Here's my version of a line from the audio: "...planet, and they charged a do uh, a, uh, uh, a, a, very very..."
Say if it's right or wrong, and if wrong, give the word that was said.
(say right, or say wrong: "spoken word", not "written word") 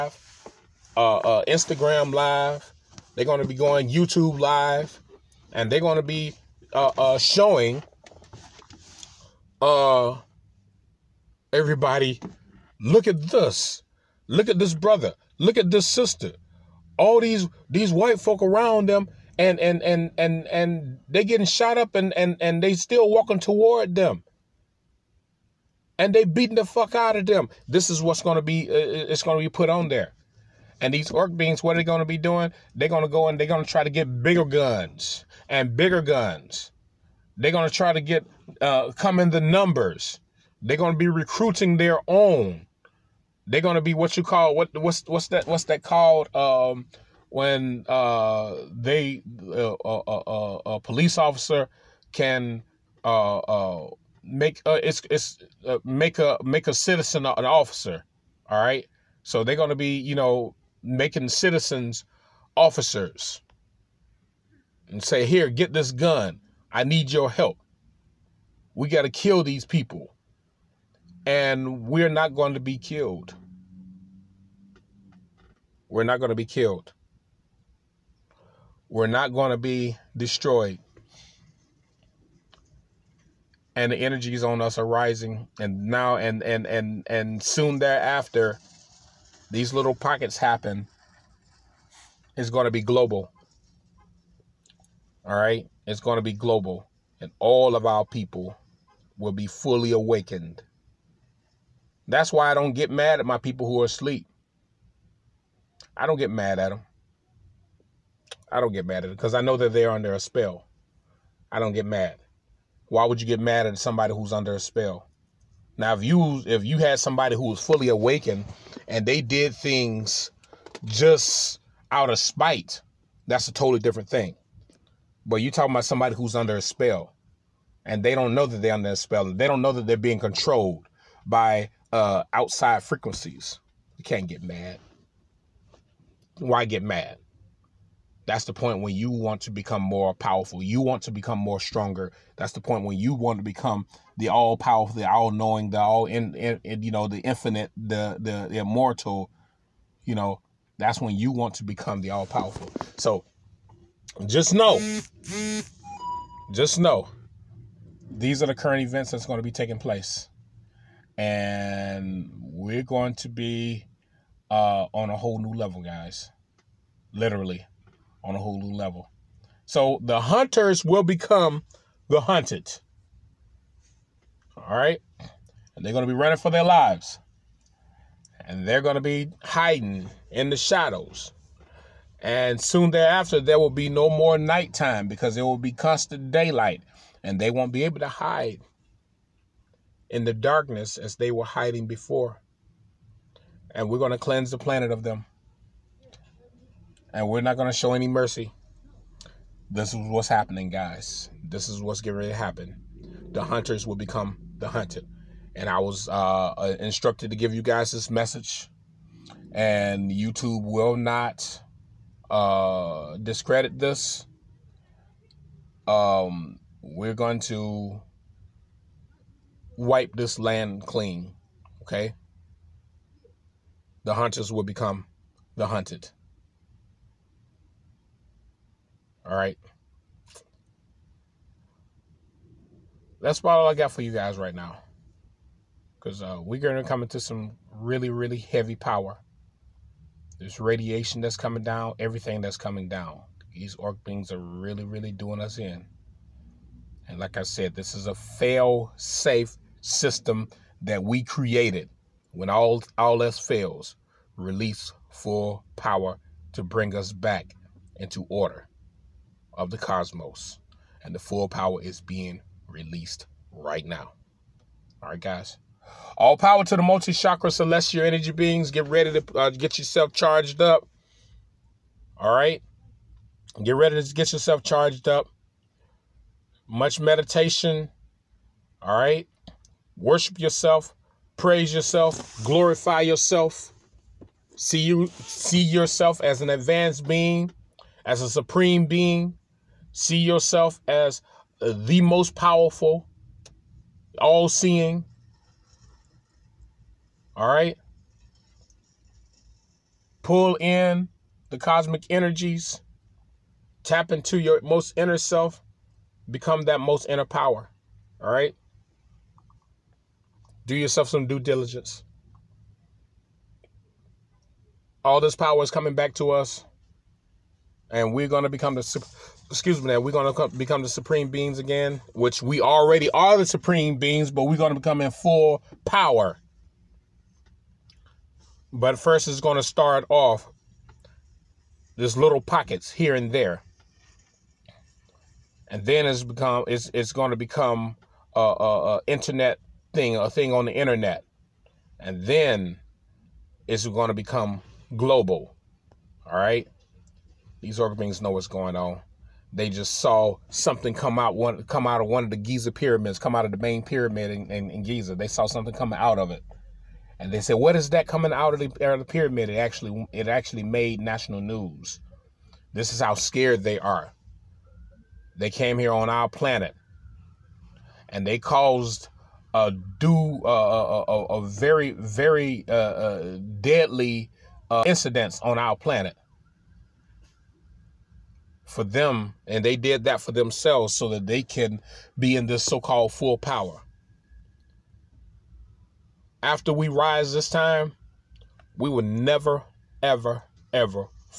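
wrong: "caused", not "charged".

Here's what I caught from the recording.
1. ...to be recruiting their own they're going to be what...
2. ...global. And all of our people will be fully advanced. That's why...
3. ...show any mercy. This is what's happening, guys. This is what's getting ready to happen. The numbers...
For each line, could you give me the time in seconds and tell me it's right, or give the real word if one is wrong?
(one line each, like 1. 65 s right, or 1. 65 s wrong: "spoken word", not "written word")
1. 40 s right
2. 96 s wrong: "awakened", not "advanced"
3. 197 s wrong: "hunters", not "numbers".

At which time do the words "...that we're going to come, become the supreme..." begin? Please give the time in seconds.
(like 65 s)
319 s.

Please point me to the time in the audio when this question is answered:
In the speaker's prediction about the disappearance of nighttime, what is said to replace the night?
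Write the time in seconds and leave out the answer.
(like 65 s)
185 s.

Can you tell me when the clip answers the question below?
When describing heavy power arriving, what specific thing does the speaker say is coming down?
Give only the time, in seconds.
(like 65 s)
240 s.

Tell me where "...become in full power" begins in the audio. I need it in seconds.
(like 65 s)
324 s.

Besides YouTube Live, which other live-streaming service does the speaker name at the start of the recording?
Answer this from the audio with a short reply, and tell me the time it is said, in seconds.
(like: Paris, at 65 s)
Instagram Live, at 1 s.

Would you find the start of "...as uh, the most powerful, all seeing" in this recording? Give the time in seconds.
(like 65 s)
290 s.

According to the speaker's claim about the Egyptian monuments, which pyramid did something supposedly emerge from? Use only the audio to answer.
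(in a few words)
the main pyramid.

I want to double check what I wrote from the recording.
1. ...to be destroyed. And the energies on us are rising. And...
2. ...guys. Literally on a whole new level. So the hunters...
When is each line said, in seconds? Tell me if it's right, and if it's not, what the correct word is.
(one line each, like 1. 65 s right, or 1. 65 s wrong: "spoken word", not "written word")
1. 79 s right
2. 165 s right.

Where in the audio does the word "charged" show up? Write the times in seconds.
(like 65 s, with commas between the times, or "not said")
270 s, 274 s.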